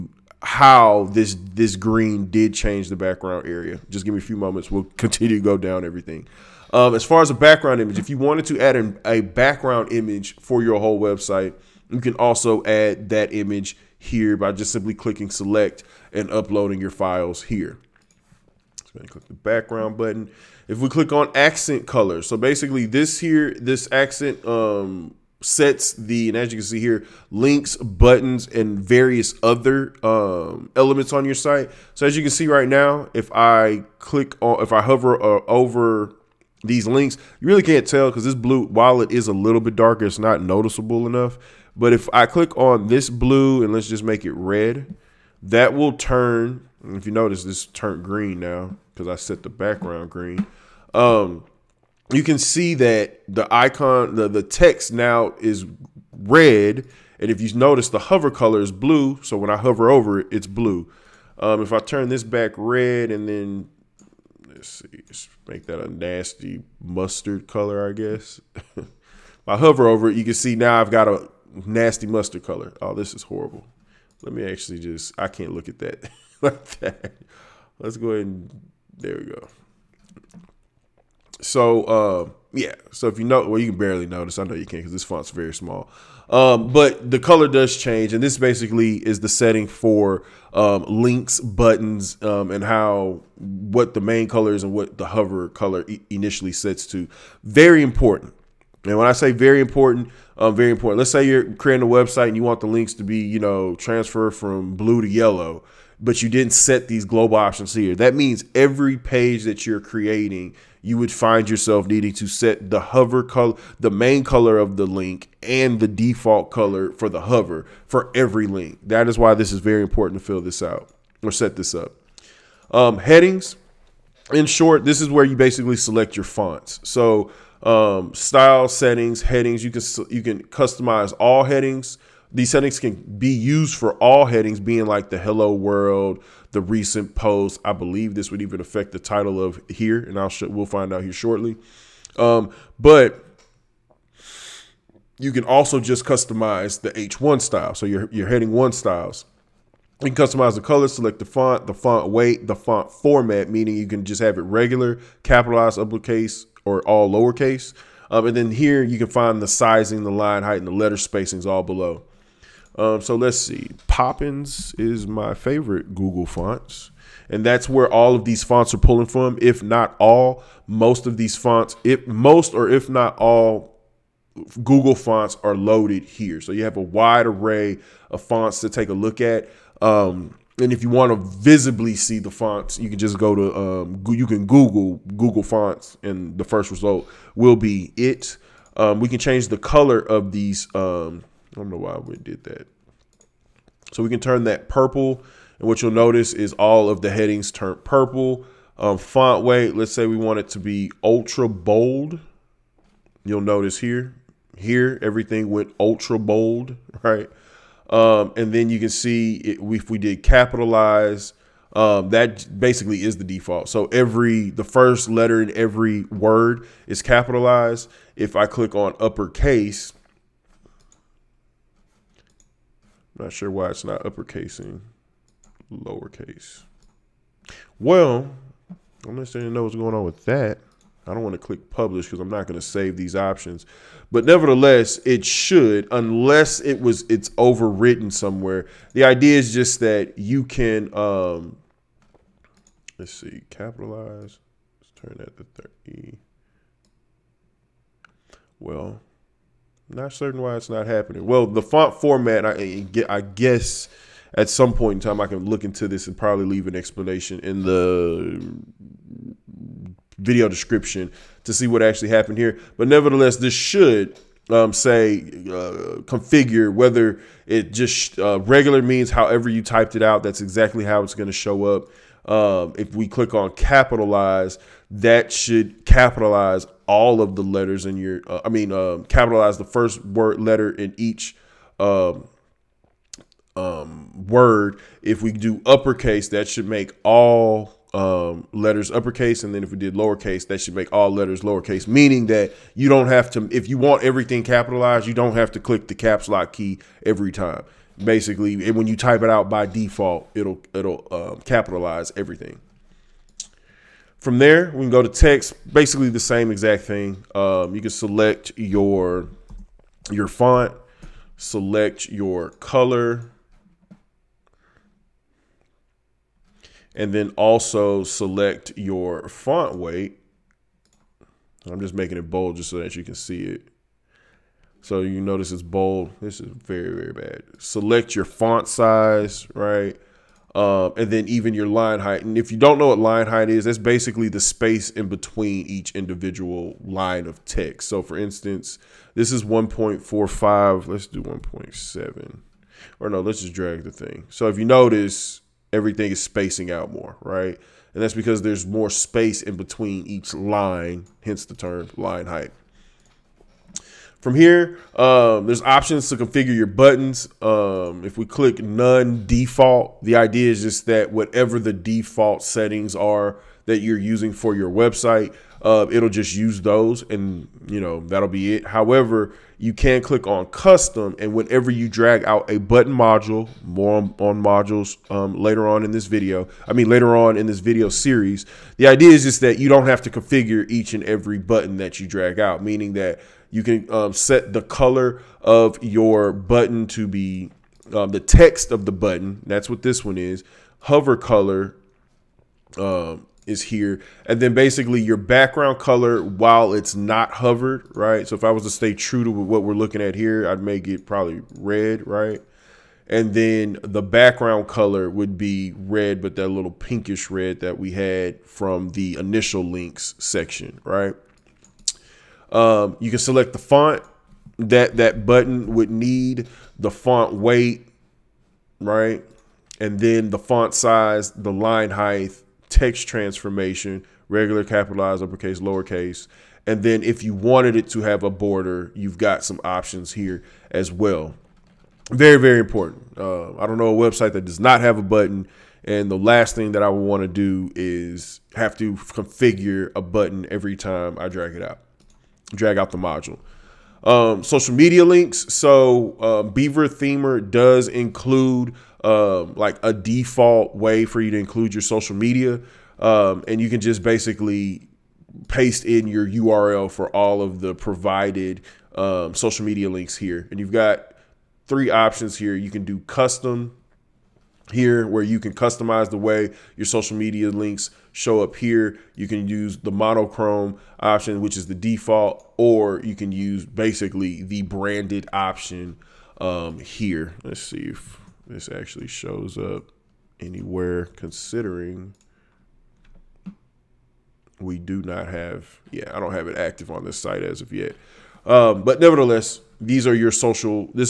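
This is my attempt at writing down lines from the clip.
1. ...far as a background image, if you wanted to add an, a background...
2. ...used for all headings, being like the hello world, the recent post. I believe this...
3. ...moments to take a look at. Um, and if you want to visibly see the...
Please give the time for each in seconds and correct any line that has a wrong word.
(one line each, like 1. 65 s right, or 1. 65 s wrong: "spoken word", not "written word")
1. 7 s right
2. 133 s right
3. 178 s wrong: "fonts", not "moments".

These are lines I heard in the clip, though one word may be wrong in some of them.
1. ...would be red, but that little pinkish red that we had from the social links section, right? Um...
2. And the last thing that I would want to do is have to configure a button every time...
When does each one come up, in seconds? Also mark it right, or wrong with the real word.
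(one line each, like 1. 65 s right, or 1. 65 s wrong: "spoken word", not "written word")
1. 405 s wrong: "initial", not "social"
2. 435 s right.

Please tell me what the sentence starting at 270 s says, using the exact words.
That's exactly how it's going to show up.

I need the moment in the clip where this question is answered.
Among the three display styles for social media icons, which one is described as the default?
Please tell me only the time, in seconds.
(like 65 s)
469 s.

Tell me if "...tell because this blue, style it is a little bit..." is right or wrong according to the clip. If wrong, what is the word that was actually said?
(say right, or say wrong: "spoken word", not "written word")
wrong: "while", not "style".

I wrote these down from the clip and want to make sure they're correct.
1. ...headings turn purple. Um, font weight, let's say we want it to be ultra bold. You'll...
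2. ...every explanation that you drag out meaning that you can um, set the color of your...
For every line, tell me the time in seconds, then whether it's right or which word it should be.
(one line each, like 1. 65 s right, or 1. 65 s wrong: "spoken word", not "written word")
1. 197 s right
2. 381 s wrong: "button", not "explanation".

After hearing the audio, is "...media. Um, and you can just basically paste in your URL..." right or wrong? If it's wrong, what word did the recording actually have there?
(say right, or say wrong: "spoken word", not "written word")
right.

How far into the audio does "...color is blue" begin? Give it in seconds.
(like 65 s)
58 s.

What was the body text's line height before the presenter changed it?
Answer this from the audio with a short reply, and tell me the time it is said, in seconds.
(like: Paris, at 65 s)
1.45, at 339 s.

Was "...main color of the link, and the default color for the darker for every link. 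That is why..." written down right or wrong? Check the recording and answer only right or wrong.
wrong.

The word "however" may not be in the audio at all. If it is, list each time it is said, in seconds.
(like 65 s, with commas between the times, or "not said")
269 s, 368 s.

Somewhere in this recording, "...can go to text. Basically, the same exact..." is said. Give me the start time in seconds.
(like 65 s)
304 s.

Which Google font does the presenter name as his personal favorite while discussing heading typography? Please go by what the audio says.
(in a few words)
Poppins.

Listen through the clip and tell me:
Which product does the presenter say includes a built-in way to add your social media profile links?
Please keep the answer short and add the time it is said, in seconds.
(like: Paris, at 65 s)
Beaver Themer, at 446 s.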